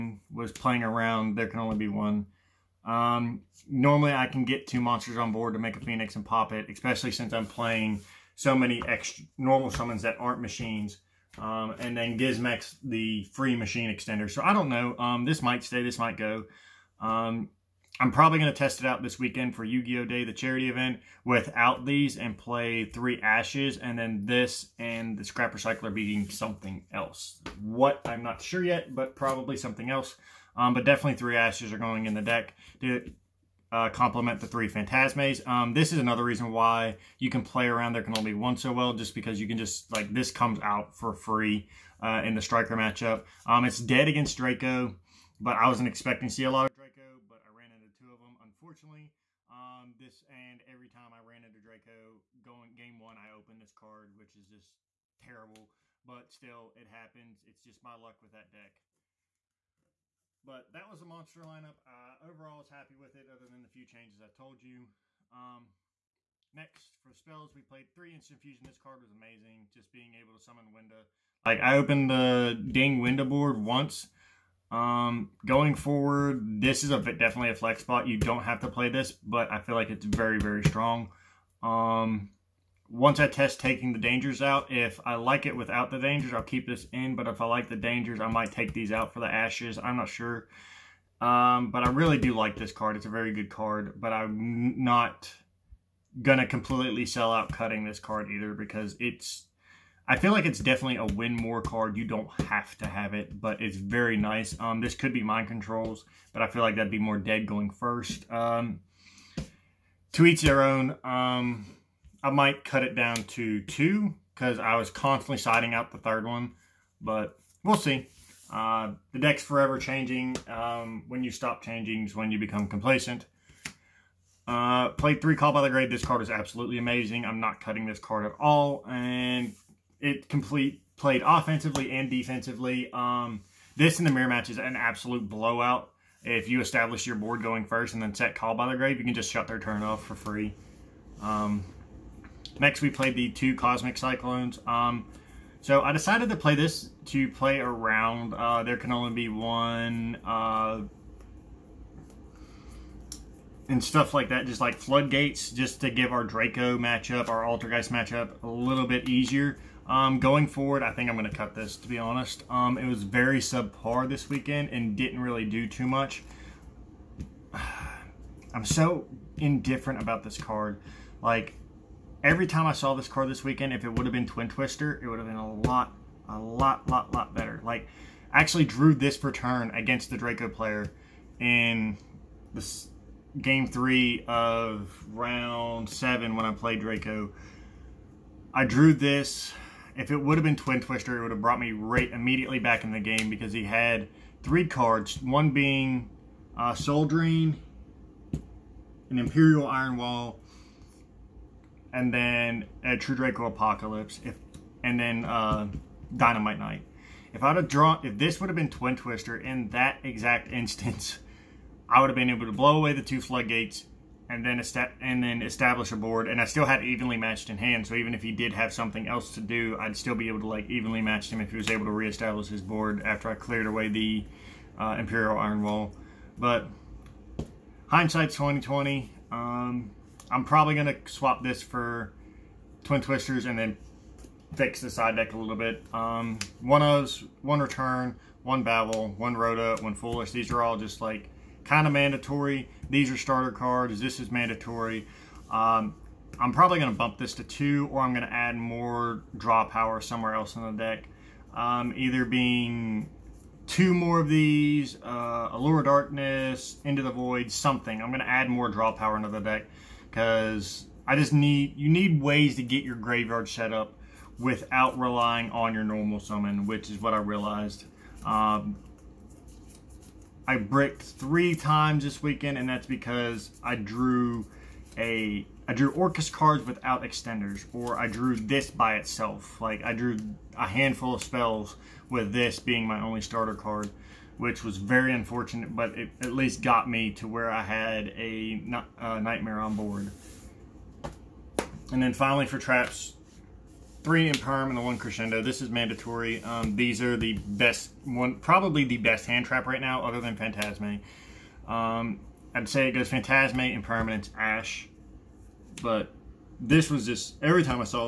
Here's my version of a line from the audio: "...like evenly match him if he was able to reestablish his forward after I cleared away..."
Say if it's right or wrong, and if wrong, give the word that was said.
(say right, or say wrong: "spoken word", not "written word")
wrong: "board", not "forward".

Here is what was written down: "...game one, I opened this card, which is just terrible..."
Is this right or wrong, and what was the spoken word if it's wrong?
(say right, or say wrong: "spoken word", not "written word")
right.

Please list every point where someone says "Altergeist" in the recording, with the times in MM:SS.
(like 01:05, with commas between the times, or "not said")
02:37.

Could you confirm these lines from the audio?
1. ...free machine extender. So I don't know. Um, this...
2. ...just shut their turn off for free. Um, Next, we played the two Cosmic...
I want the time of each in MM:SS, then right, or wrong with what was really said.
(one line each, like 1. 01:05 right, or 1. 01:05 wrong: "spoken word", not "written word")
1. 00:13 right
2. 02:19 right.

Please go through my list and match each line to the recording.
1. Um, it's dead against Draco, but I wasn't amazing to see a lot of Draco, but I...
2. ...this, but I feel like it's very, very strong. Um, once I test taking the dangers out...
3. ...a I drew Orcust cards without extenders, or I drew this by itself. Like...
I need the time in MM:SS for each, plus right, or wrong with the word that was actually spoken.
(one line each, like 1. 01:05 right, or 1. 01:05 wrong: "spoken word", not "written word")
1. 00:43 wrong: "expecting", not "amazing"
2. 01:18 right
3. 04:34 right.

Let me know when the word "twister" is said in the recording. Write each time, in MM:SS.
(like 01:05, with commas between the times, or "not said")
02:54, 03:10, 03:28, 03:53.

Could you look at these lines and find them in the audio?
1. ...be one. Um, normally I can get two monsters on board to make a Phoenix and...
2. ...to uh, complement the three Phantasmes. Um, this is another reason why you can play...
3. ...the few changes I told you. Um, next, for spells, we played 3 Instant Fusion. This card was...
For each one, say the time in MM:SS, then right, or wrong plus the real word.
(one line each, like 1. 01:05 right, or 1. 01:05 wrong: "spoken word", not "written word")
1. 00:01 right
2. 00:32 right
3. 01:03 right.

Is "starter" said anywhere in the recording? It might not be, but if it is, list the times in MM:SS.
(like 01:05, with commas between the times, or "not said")
04:03, 04:43.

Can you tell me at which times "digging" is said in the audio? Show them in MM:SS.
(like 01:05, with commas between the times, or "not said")
not said.